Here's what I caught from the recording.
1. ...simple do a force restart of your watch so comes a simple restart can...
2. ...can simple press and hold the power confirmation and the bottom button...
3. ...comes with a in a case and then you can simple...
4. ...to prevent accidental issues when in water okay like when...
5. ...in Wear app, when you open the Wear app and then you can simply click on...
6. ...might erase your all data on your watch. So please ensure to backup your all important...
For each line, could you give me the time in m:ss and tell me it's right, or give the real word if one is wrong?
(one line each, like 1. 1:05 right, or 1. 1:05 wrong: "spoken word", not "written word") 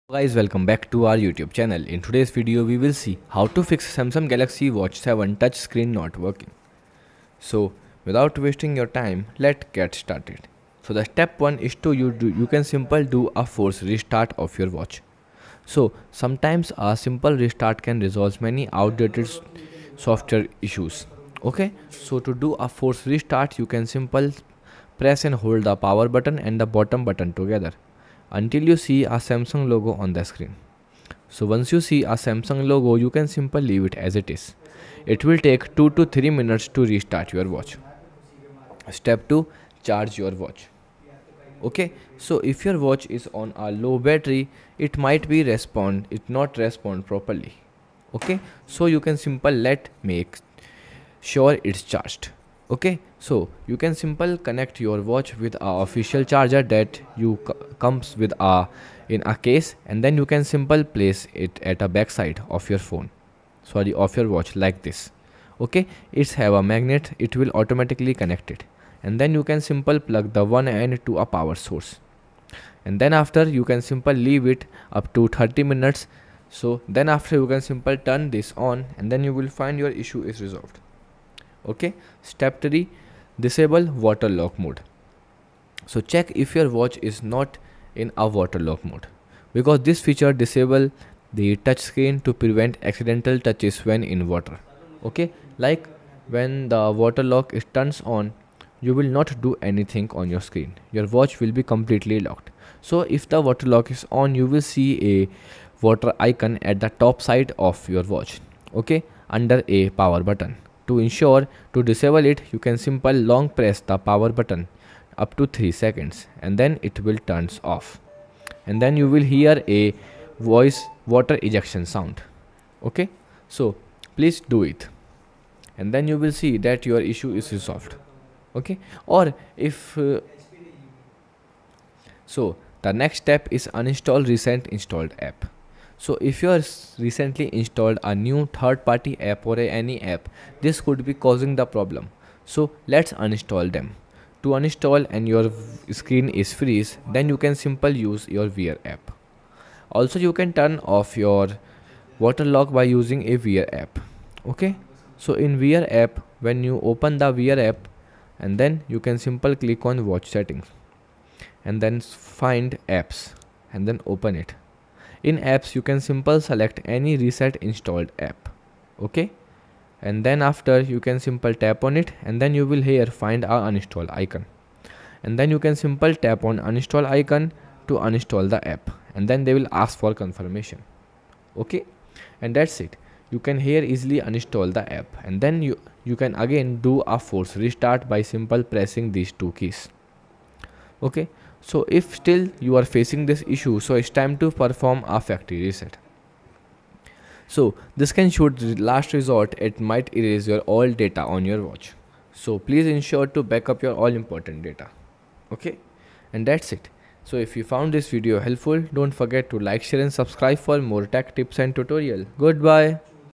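1. 0:12 wrong: "sometimes", not "comes"
2. 0:23 wrong: "button", not "confirmation"
3. 0:57 right
4. 1:32 wrong: "touches", not "issues"
5. 2:35 right
6. 3:19 right.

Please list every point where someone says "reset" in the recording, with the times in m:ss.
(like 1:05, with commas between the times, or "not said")
2:47, 3:15.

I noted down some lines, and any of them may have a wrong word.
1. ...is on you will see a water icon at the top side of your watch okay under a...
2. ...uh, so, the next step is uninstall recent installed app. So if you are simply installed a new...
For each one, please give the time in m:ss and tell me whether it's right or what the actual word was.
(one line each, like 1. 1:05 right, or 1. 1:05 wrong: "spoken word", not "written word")
1. 1:43 right
2. 2:09 wrong: "recently", not "simply".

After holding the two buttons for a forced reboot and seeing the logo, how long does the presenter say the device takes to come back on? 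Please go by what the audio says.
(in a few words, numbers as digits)
2 to 3 minutes.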